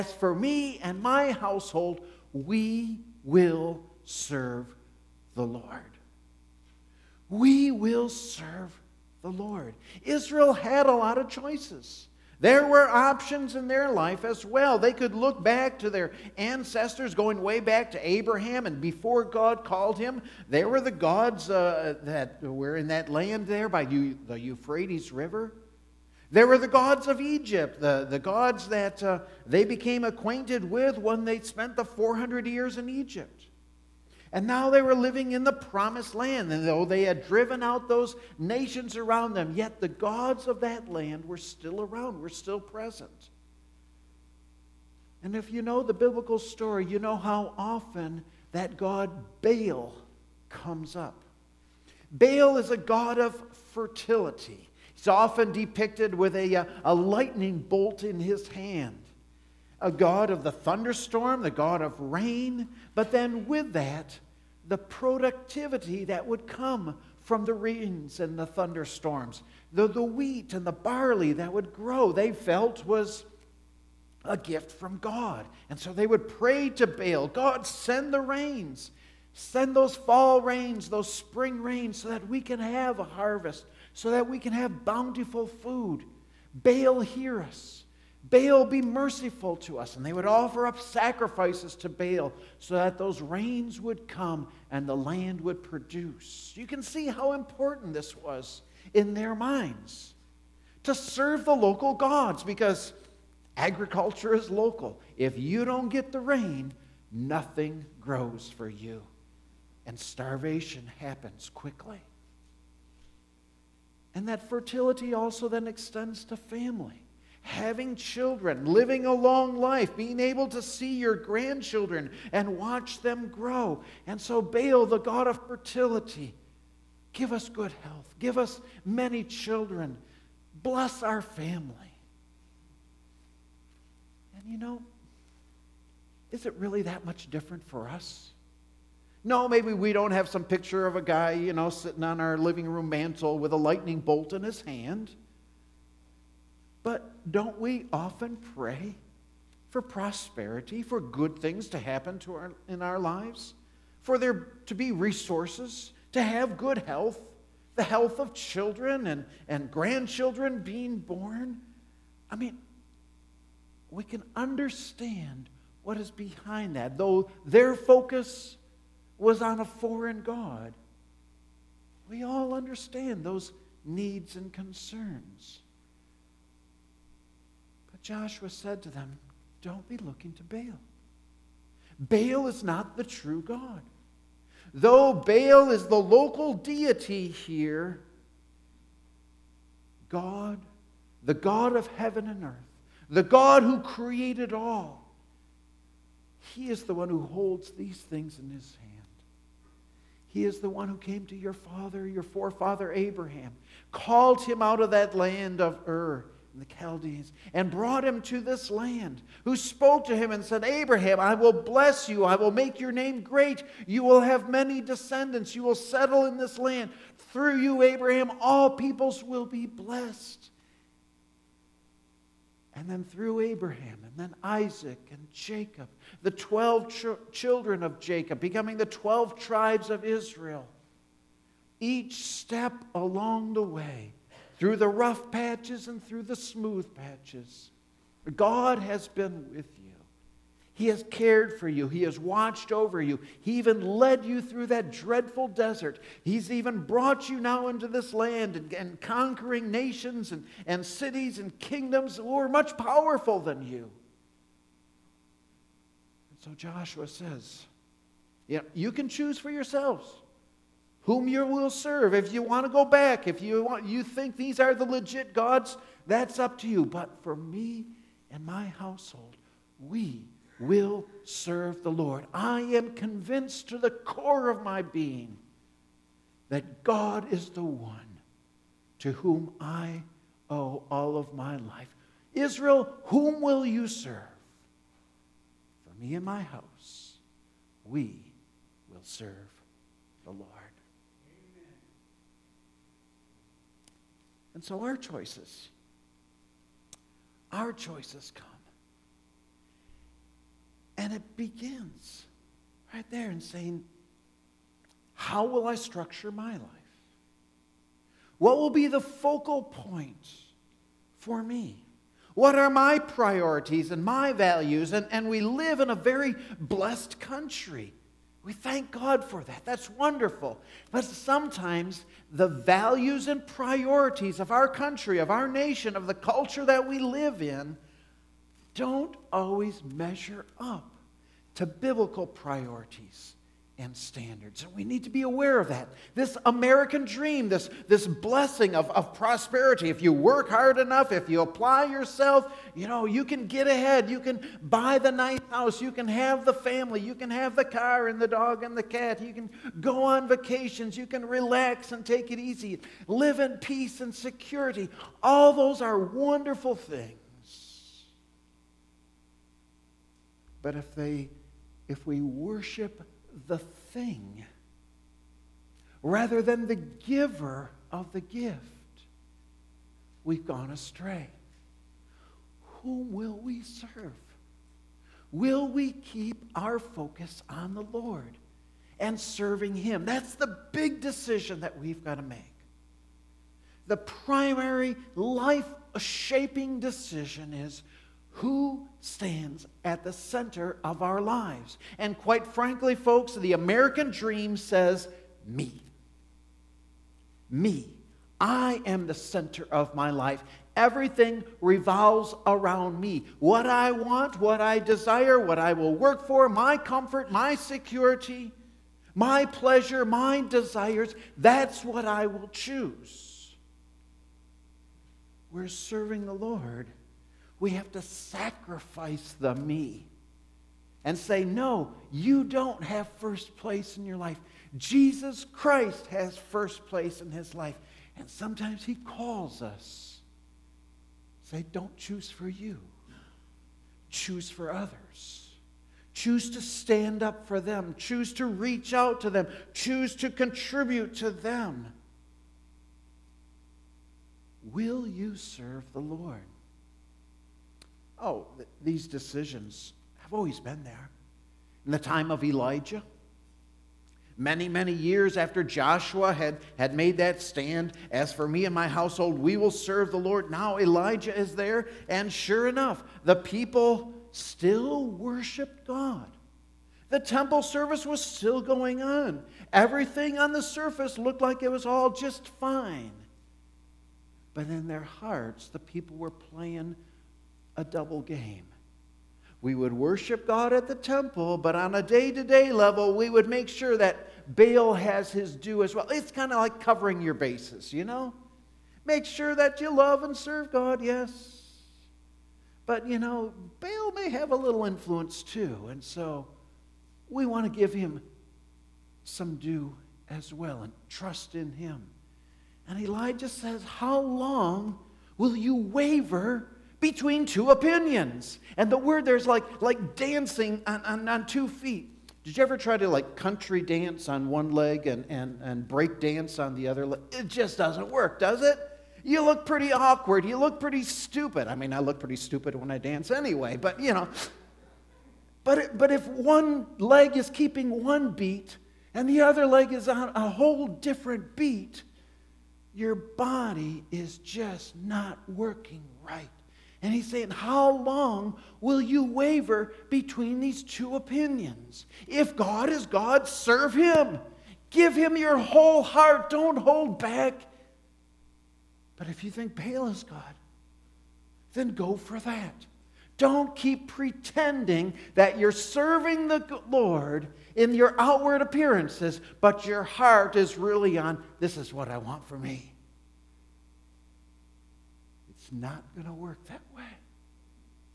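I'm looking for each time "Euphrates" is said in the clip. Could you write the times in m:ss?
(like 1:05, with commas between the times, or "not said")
0:24.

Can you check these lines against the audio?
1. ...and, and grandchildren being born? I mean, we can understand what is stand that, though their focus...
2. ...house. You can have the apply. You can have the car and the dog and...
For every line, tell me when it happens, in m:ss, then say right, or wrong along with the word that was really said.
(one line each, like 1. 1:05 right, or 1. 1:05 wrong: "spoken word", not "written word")
1. 2:39 wrong: "behind", not "stand"
2. 5:45 wrong: "family", not "apply".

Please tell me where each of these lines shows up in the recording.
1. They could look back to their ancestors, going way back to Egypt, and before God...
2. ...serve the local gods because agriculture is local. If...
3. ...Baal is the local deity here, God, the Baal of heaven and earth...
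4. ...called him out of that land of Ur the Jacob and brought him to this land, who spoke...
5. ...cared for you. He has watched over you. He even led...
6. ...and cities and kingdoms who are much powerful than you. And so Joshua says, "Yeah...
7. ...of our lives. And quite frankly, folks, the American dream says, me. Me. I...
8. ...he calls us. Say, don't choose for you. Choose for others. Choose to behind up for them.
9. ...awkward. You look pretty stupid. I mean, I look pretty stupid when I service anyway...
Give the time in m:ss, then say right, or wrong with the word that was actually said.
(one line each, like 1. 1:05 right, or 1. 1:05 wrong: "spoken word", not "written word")
1. 0:14 wrong: "Abraham", not "Egypt"
2. 1:40 right
3. 3:05 wrong: "God", not "Baal"
4. 3:23 wrong: "Chaldeans", not "Jacob"
5. 4:01 right
6. 4:10 right
7. 6:30 right
8. 7:08 wrong: "stand", not "behind"
9. 8:39 wrong: "dance", not "service".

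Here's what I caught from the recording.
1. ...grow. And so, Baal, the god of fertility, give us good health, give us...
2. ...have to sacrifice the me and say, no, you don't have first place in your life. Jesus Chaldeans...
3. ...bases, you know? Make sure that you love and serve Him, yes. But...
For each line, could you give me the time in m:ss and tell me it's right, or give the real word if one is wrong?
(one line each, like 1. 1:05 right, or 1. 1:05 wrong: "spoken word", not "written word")
1. 2:03 right
2. 6:57 wrong: "Christ", not "Chaldeans"
3. 8:07 wrong: "God", not "Him".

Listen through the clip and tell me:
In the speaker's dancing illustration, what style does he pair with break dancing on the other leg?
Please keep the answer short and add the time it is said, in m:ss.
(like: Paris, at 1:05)
country dance, at 8:33.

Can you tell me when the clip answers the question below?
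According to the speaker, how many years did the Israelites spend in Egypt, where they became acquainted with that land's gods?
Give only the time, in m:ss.
0:31.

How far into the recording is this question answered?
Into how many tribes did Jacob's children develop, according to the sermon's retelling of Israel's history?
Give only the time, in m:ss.
3:48.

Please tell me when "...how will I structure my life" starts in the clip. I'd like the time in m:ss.
5:05.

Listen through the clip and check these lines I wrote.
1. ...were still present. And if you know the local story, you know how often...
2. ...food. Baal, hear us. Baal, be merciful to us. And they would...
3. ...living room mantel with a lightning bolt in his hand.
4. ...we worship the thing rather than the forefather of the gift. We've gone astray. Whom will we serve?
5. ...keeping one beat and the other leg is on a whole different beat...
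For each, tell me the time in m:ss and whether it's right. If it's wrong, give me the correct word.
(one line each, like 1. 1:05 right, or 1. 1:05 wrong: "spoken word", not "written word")
1. 0:42 wrong: "biblical", not "local"
2. 1:25 right
3. 2:22 right
4. 6:02 wrong: "giver", not "forefather"
5. 8:47 right.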